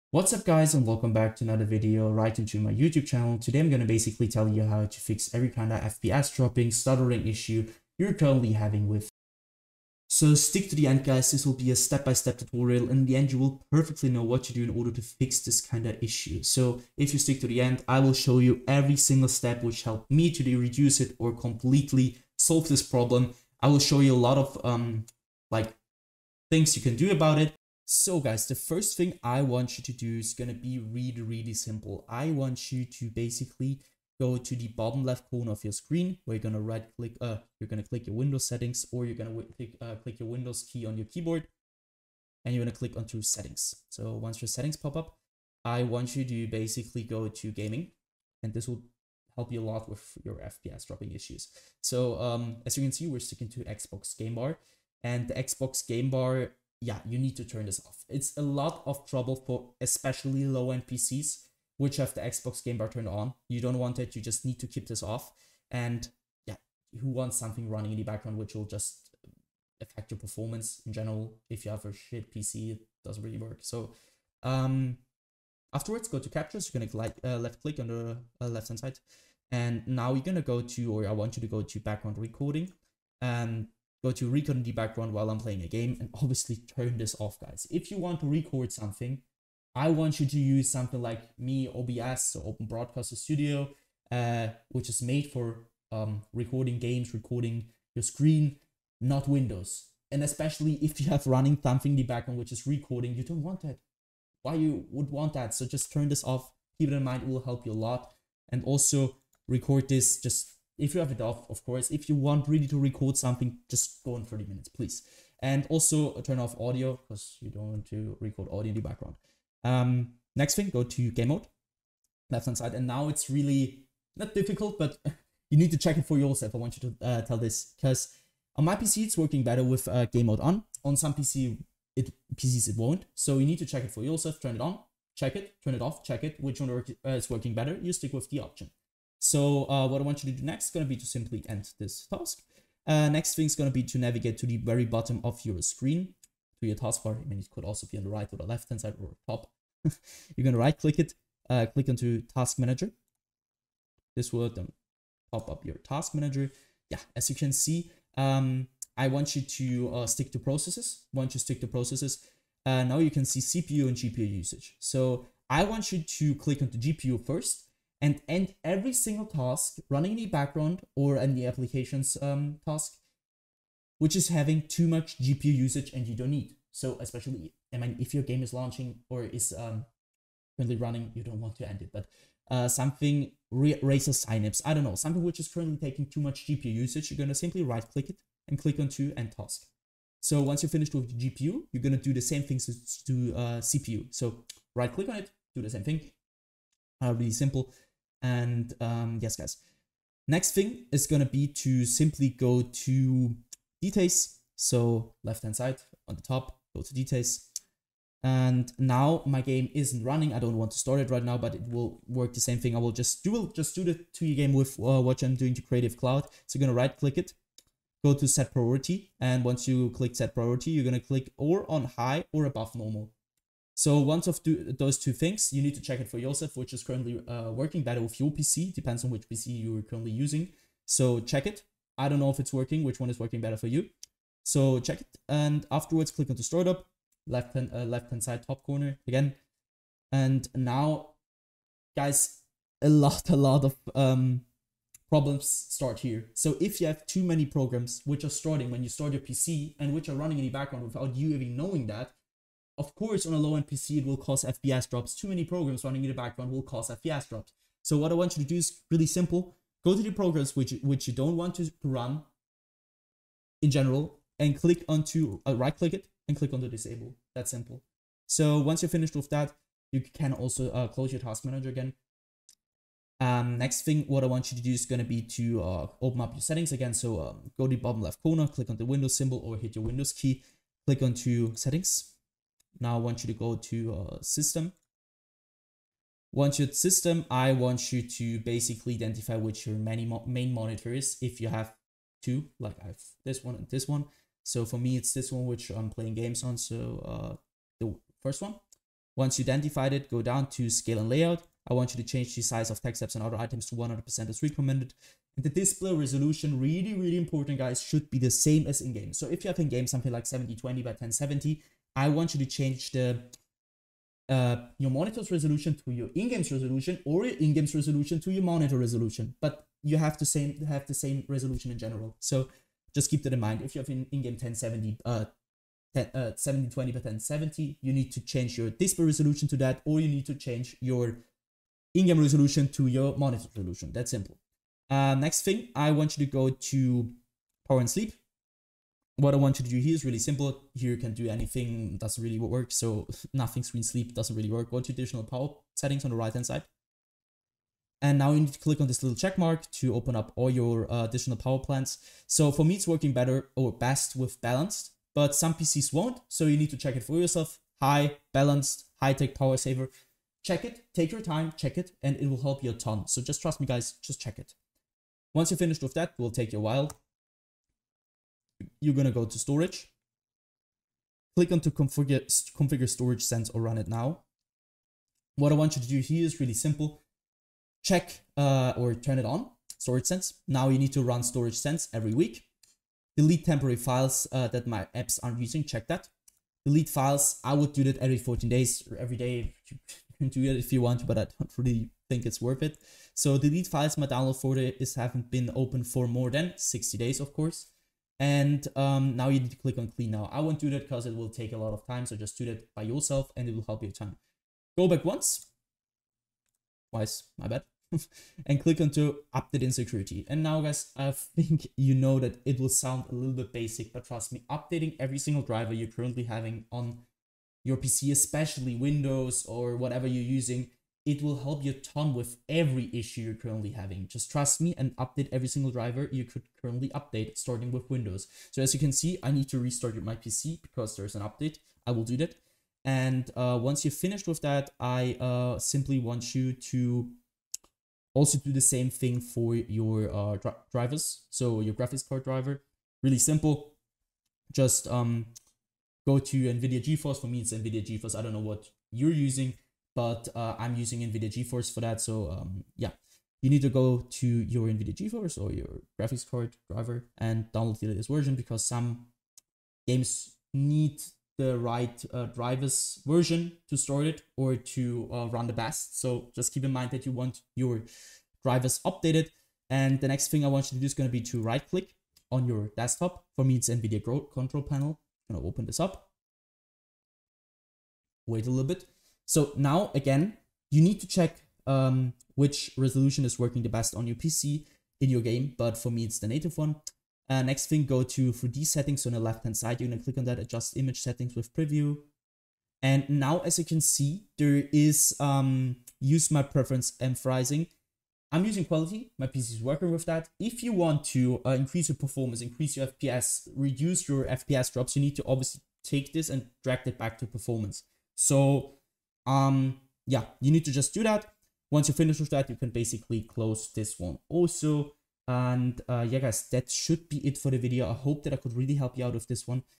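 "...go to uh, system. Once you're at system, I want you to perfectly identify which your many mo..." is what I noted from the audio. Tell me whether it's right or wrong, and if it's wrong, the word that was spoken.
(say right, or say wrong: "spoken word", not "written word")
wrong: "basically", not "perfectly".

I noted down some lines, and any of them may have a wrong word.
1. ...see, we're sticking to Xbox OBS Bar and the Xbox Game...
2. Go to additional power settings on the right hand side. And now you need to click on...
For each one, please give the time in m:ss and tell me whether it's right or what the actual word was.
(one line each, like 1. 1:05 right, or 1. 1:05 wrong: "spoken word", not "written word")
1. 0:52 wrong: "Game", not "OBS"
2. 5:44 right.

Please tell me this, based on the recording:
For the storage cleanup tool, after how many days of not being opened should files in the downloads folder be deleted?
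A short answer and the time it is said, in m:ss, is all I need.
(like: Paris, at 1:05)
60, at 6:36.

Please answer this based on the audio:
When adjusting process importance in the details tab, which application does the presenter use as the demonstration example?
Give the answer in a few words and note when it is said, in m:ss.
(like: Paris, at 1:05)
Creative Cloud, at 3:35.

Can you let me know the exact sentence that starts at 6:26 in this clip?
Delete files, I would do that every 14 days or every day.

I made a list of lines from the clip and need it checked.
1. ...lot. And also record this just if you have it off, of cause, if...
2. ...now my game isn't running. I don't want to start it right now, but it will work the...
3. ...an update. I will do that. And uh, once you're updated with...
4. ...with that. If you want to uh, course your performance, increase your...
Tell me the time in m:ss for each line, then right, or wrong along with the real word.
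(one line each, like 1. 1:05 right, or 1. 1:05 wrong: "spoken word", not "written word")
1. 1:47 wrong: "course", not "cause"
2. 3:28 right
3. 7:11 wrong: "finished", not "updated"
4. 8:19 wrong: "increase", not "course".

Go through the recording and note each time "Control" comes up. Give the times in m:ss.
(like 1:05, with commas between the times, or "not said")
7:54.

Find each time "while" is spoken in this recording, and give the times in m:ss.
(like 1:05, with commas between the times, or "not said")
1:25, 6:06.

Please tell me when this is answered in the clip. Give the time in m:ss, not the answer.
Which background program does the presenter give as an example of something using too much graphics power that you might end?
3:03.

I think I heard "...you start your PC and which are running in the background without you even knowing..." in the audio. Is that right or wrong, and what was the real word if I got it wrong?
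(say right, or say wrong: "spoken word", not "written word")
right.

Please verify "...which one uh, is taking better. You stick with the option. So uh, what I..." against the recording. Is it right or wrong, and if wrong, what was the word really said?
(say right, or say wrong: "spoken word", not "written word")
wrong: "working", not "taking".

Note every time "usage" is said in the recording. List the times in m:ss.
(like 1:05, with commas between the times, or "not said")
2:44, 2:55, 3:06.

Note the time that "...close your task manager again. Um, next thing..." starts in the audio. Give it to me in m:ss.
4:30.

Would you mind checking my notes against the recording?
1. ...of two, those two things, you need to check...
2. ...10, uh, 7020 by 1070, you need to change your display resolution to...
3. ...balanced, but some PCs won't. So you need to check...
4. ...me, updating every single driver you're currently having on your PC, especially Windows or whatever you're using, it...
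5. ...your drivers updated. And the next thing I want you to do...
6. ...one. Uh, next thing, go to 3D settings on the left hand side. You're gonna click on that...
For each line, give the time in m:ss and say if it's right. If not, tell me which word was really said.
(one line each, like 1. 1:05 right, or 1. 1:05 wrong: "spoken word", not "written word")
1. 3:44 right
2. 5:25 right
3. 5:54 right
4. 6:54 right
5. 7:47 right
6. 8:06 right.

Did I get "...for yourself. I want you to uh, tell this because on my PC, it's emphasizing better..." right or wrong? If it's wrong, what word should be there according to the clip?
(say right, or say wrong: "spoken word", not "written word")
wrong: "working", not "emphasizing".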